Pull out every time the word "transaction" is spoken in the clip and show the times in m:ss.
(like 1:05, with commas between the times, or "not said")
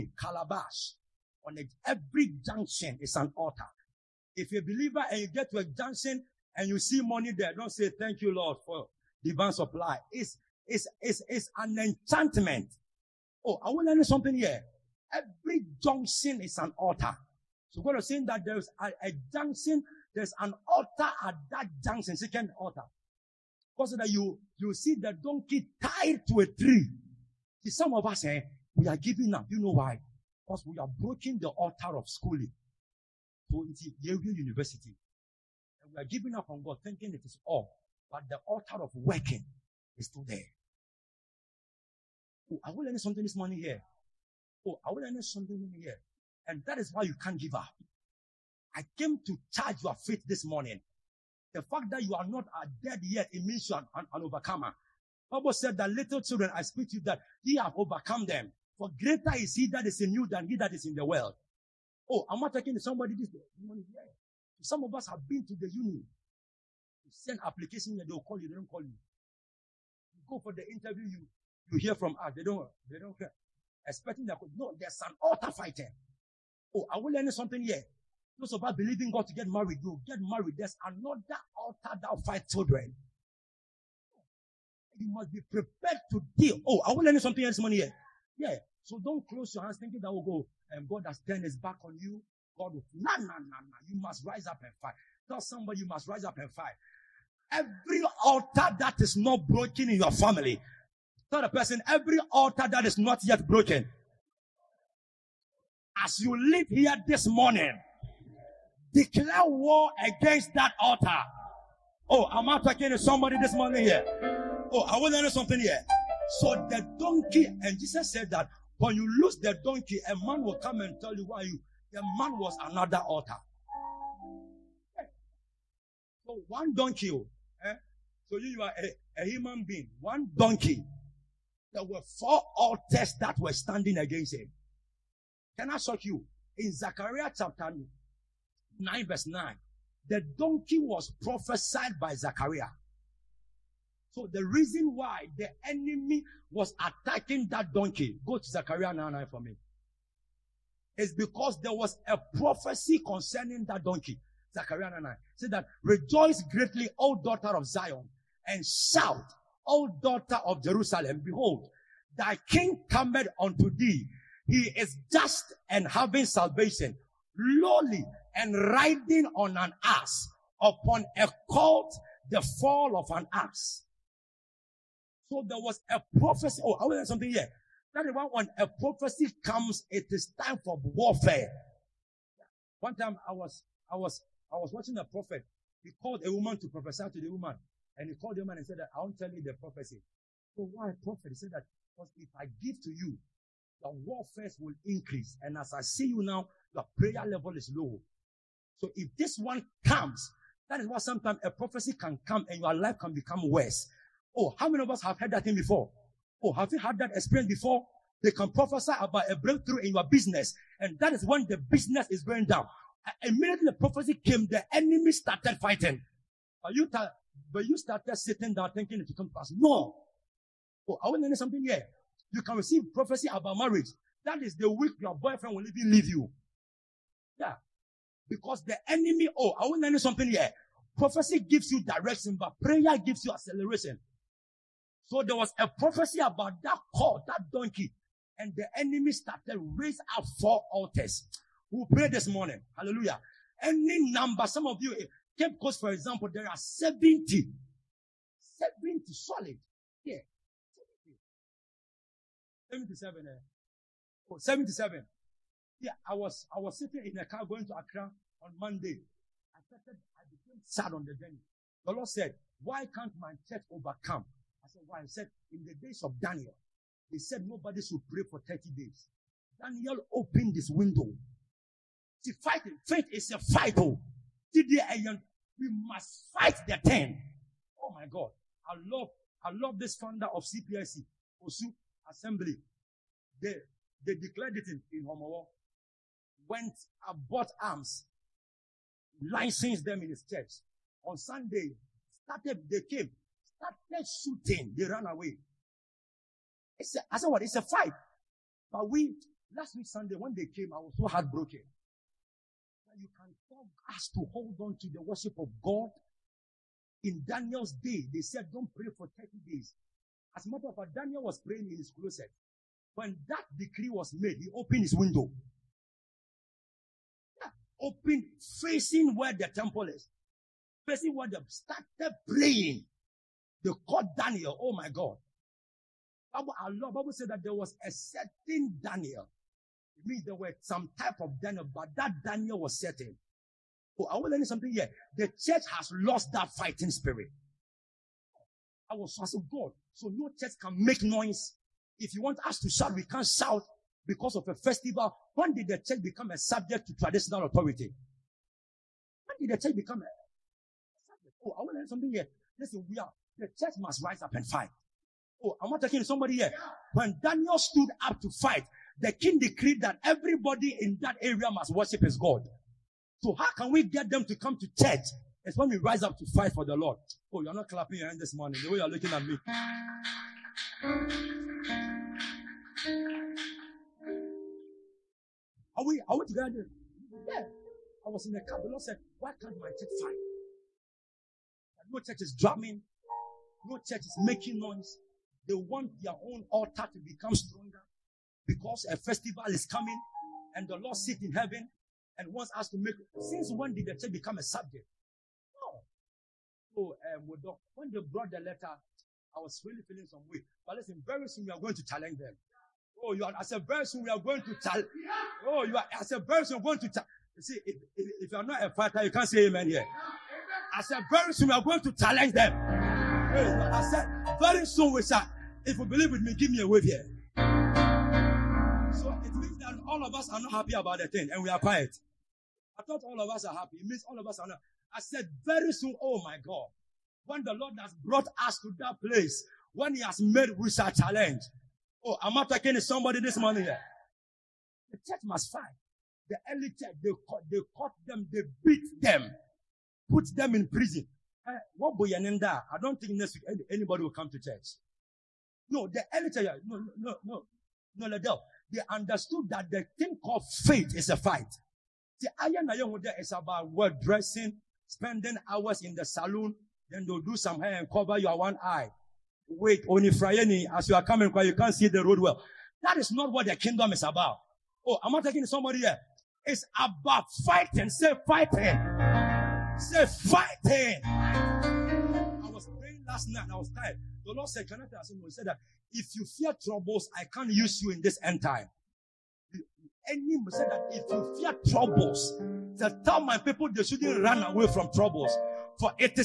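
not said.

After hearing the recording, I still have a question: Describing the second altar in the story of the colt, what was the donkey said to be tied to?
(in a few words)
a tree.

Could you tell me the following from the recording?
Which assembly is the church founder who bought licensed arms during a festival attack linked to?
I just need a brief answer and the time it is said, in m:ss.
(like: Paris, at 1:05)
Osu Assembly, at 4:41.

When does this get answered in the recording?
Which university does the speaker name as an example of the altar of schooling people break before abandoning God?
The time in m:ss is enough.
0:34.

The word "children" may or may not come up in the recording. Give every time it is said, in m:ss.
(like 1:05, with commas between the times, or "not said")
0:56, 1:22.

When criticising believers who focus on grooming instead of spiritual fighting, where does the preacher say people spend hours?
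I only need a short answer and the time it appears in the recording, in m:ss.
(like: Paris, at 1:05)
saloon, at 7:36.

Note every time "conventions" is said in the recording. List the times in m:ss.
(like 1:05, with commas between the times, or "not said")
not said.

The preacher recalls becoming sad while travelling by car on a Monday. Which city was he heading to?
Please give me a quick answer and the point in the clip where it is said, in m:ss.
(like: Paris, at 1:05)
Accra, at 4:17.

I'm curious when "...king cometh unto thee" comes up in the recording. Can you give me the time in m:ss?
2:42.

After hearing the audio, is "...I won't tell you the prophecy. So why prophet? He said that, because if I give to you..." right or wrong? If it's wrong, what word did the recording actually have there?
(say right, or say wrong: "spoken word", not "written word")
right.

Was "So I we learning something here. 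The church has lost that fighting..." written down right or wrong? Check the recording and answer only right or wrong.
right.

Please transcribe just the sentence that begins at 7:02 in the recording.
I thought all of us are happy.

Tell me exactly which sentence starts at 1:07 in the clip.
You send application and they'll call you, they don't call you.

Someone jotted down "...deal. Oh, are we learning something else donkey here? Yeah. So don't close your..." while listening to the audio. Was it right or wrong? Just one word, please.
wrong.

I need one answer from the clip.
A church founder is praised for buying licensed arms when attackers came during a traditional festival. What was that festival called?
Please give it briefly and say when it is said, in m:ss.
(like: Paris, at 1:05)
Homowo, at 4:45.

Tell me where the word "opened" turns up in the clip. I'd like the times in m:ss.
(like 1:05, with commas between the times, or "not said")
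4:30, 5:14.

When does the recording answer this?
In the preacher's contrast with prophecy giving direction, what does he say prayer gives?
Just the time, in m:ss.
3:53.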